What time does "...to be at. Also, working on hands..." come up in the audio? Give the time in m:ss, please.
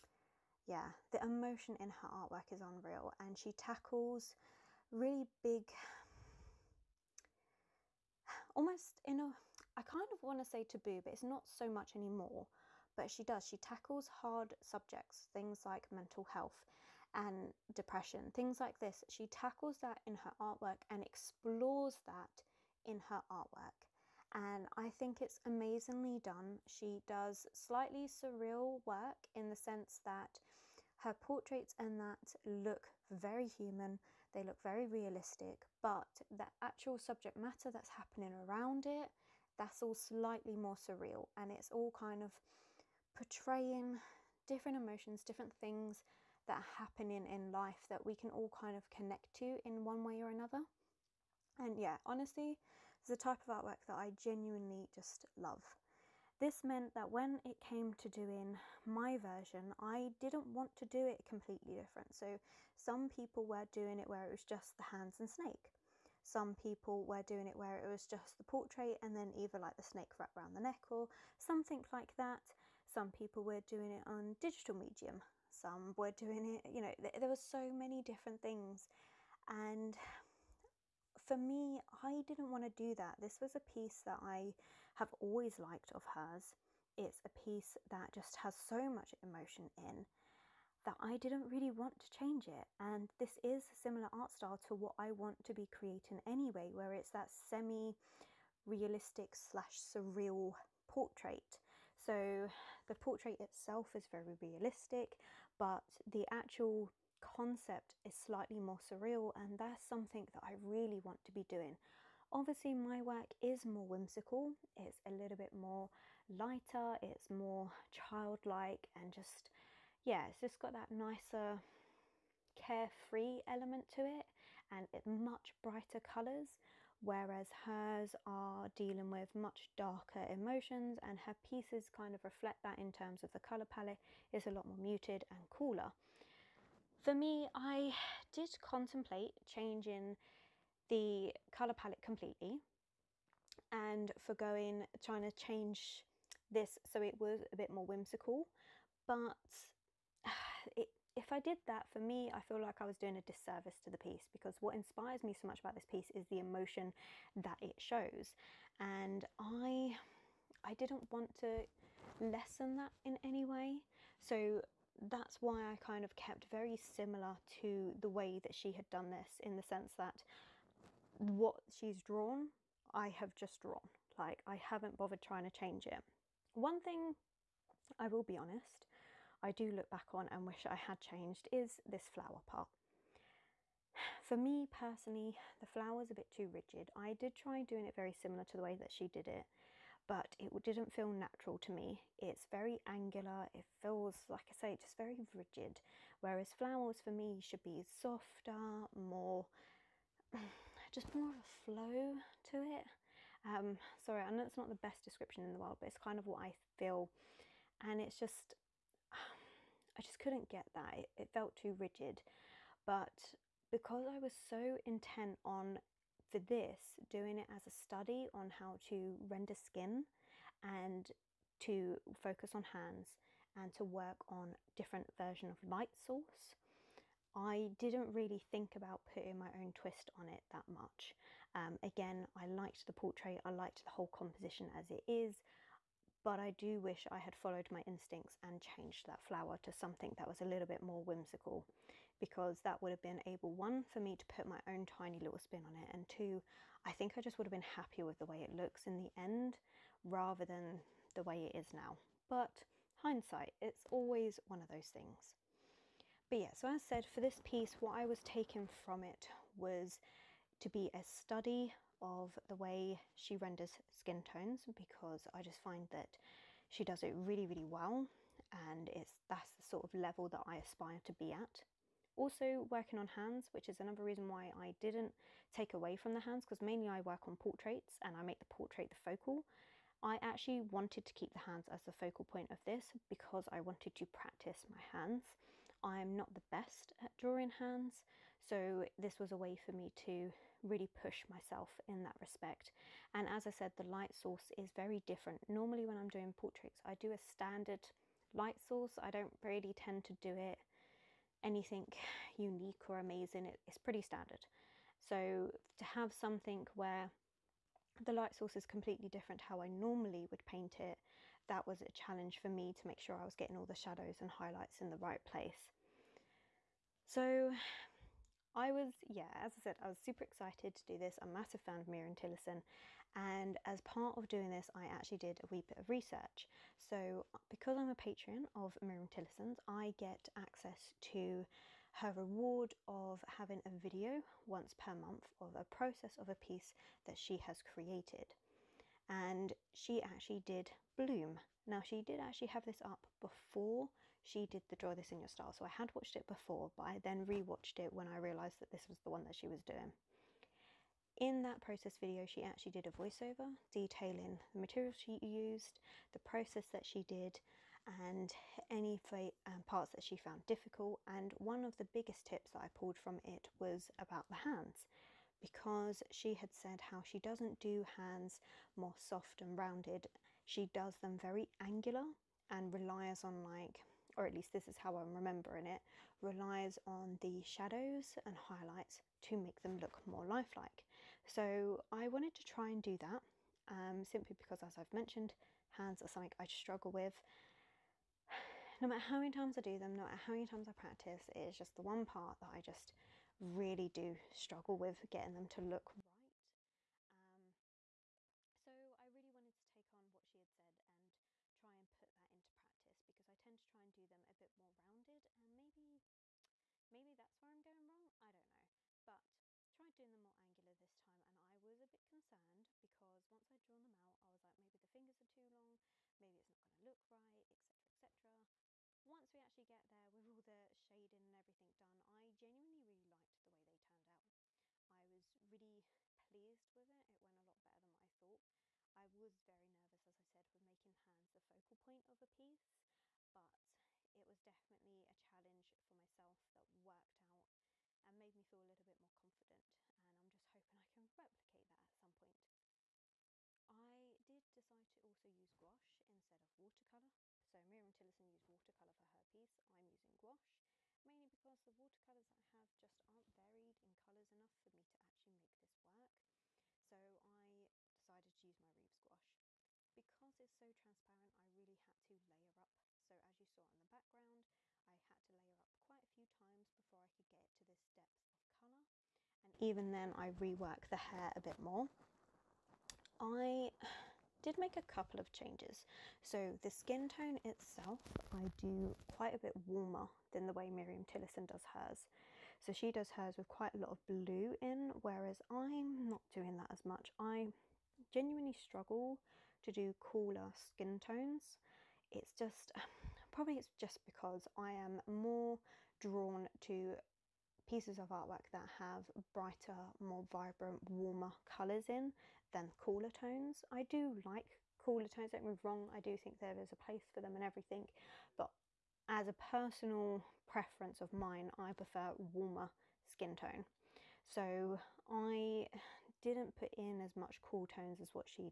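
4:31.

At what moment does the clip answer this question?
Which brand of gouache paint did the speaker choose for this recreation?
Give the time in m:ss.
7:38.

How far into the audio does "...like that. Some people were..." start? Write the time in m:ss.
1:11.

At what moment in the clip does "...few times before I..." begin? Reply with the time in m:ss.
7:46.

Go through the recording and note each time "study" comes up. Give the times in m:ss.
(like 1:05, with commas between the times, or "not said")
3:37, 4:21.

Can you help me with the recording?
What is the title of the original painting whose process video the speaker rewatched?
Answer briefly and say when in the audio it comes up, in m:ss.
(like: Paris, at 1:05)
Bloom, at 5:40.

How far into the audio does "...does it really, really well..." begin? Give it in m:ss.
4:26.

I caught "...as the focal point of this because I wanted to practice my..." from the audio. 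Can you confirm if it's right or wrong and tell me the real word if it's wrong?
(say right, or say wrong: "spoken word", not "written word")
right.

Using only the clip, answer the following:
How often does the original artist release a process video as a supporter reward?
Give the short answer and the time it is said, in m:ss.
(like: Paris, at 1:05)
once per month, at 5:34.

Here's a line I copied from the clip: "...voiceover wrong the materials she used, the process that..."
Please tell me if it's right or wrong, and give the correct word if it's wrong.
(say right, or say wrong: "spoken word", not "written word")
wrong: "detailing", not "wrong".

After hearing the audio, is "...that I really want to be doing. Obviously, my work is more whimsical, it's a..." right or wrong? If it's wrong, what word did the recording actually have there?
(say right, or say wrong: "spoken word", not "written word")
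right.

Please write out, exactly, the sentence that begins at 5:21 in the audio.
I'm a massive fan of Myriam Tillison, and as part of doing this, I actually did a wee bit of research.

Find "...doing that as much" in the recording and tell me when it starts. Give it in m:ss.
8:06.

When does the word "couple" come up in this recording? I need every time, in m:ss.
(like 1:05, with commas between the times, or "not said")
7:54.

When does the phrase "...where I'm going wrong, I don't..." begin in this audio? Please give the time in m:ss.
6:47.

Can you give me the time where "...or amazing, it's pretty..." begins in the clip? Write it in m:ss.
5:02.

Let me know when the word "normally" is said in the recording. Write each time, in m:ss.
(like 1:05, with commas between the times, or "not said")
4:55, 5:09.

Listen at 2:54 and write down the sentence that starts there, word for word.
Like, I haven't bothered trying to change it.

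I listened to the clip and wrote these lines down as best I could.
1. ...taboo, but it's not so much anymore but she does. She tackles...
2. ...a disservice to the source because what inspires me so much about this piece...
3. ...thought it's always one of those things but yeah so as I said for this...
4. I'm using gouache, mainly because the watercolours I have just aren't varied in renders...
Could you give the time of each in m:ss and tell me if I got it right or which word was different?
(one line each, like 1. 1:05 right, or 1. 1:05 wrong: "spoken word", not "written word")
1. 0:10 right
2. 2:33 wrong: "piece", not "source"
3. 4:13 wrong: "hindsight", not "thought"
4. 7:29 wrong: "colours", not "renders".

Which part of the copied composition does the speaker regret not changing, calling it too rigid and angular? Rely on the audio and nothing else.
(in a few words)
the flower.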